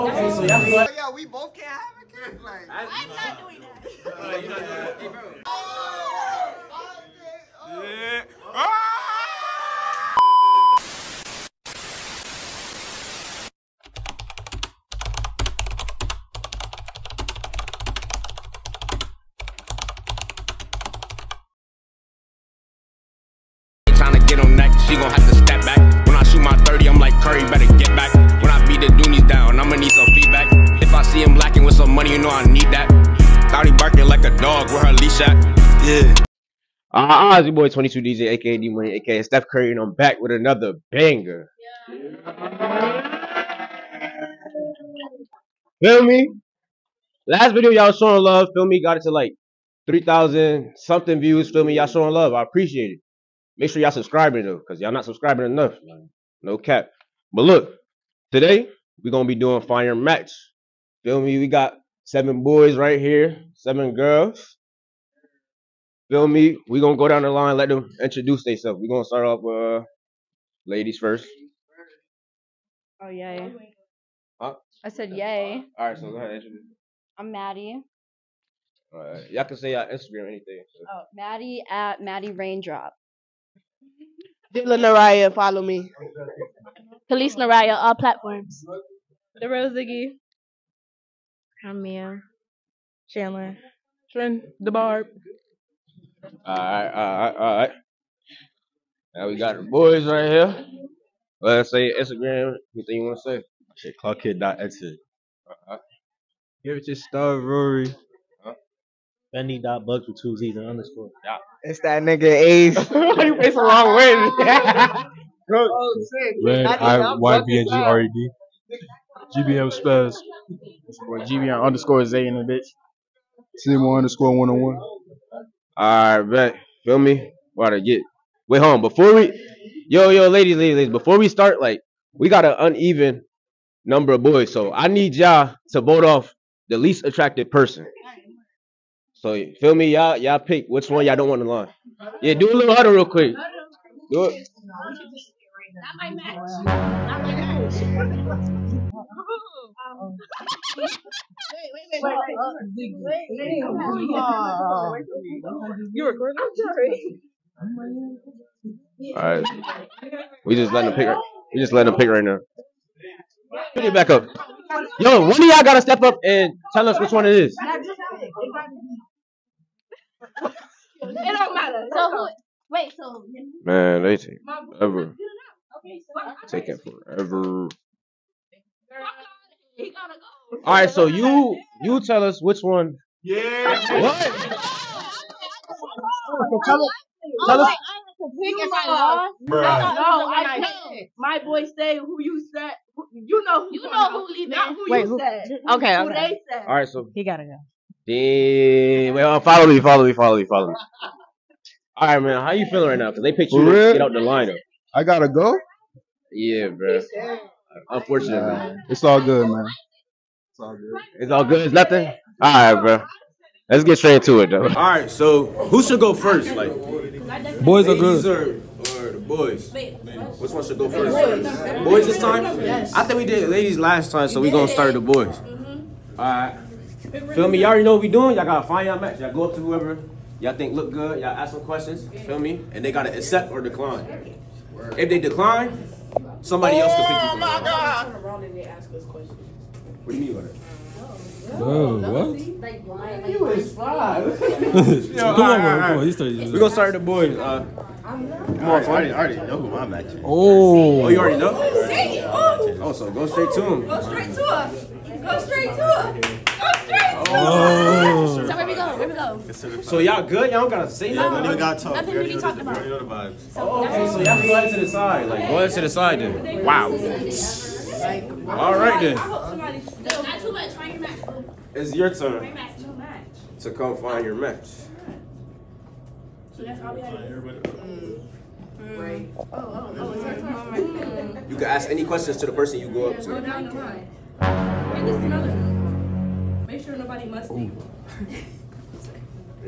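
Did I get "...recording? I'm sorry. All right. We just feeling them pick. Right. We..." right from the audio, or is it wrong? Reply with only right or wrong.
wrong.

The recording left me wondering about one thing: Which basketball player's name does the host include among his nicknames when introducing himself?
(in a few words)
Steph Curry.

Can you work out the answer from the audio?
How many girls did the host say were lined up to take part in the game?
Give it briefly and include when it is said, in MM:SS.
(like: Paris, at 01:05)
7, at 01:03.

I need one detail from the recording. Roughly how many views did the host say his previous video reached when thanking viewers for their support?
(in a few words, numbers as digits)
3,000.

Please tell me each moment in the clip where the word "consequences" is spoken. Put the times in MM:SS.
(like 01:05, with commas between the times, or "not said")
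not said.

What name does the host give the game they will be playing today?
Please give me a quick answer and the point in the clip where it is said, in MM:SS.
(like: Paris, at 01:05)
Fire Match, at 00:59.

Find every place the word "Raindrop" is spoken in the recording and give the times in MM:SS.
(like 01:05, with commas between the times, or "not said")
01:22.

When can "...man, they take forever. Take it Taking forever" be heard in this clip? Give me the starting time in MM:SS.
02:53.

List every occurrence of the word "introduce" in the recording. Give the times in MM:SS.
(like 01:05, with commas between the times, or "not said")
01:08, 01:16.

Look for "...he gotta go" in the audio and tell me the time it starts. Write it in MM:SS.
03:17.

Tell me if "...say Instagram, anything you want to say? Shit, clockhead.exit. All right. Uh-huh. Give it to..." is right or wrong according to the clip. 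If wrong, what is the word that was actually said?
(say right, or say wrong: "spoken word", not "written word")
right.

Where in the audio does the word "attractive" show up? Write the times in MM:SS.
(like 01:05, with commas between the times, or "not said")
02:17.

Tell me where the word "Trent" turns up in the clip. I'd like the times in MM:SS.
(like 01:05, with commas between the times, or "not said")
01:34.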